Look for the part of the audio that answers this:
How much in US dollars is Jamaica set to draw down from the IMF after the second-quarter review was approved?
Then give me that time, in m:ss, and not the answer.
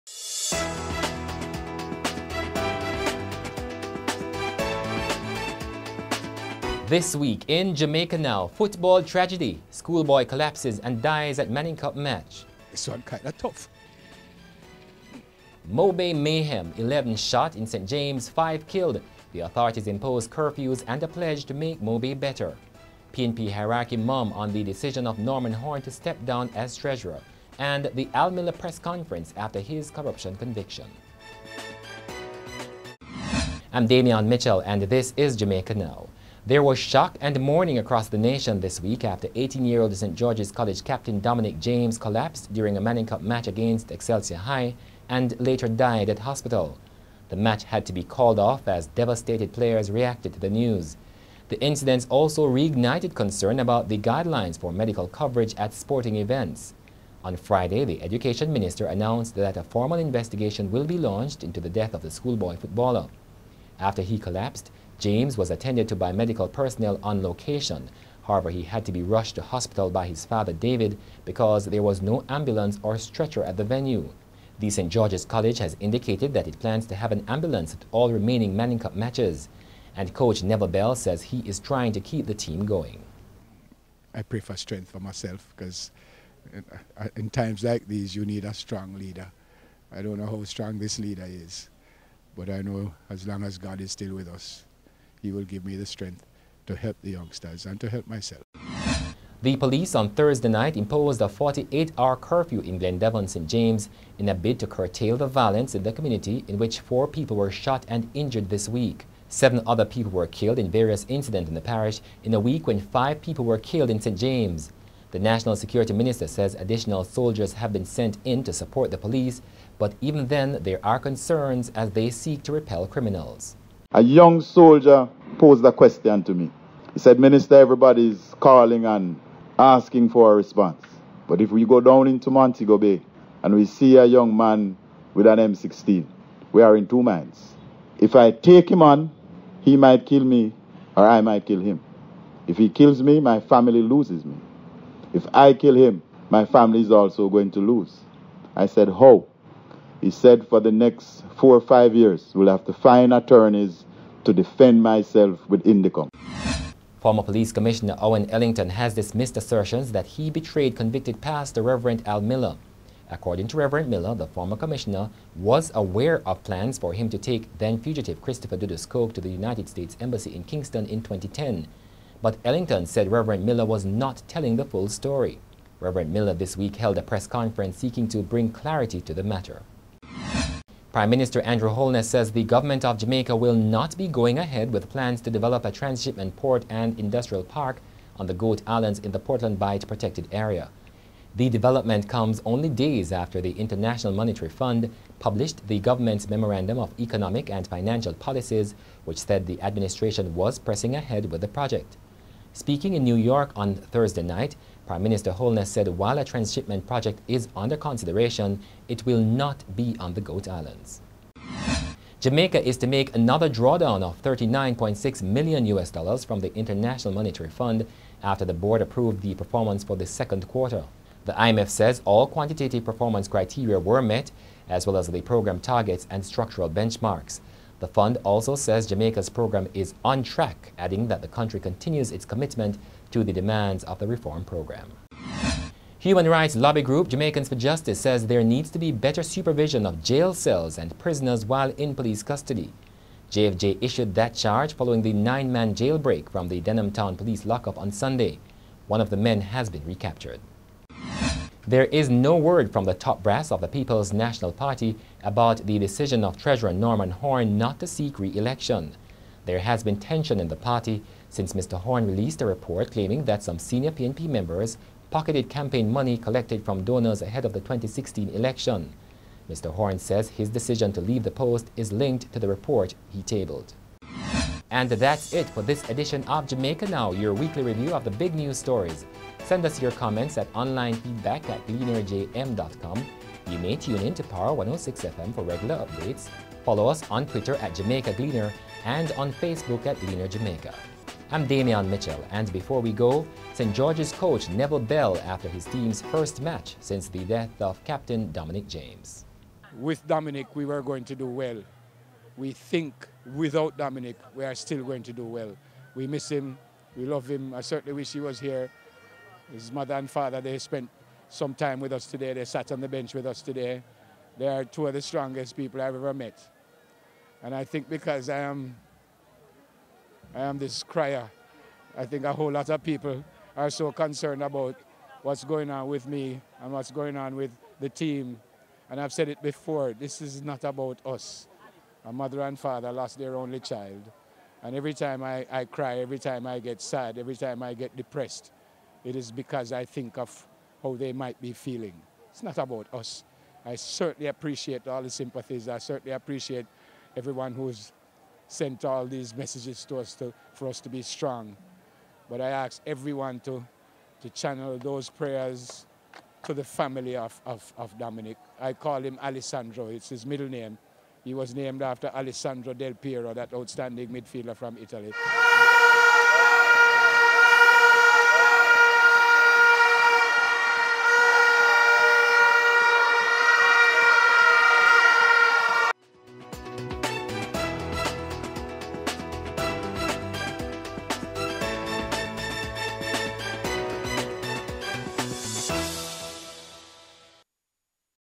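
3:34.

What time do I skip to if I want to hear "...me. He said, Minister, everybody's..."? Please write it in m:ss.
2:06.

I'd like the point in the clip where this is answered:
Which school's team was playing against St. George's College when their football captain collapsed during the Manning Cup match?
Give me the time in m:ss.
0:43.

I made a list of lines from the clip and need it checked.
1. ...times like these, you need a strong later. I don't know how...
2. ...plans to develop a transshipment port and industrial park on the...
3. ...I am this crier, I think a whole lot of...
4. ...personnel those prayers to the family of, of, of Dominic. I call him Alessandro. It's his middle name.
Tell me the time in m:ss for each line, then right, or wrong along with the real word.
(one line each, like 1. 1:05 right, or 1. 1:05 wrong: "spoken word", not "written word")
1. 1:27 wrong: "leader", not "later"
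2. 3:04 right
3. 5:20 right
4. 5:54 wrong: "channel", not "personnel".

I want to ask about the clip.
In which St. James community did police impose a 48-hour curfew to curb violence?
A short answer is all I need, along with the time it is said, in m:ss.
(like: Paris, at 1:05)
Glendevon, at 1:42.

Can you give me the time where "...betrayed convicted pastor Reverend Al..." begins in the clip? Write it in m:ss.
2:40.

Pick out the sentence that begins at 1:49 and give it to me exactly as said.
Seven other people were killed in various incidents in the parish in a week when five people were killed in St.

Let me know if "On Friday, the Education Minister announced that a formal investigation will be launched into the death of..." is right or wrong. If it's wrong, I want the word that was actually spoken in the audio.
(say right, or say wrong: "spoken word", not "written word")
right.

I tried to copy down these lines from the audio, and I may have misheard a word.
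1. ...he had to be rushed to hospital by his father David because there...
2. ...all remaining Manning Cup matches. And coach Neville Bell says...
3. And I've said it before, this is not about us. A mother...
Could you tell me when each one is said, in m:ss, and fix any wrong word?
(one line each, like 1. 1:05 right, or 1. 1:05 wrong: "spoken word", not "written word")
1. 1:08 right
2. 1:17 right
3. 5:28 right.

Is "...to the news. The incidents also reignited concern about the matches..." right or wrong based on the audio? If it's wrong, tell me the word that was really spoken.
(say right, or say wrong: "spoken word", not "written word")
wrong: "guidelines", not "matches".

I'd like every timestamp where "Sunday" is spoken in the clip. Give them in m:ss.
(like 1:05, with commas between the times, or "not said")
4:07.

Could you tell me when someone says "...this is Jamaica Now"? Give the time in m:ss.
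0:34.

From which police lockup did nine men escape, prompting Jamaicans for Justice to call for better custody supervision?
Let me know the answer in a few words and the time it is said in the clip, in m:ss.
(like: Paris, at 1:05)
Denham Town, at 4:06.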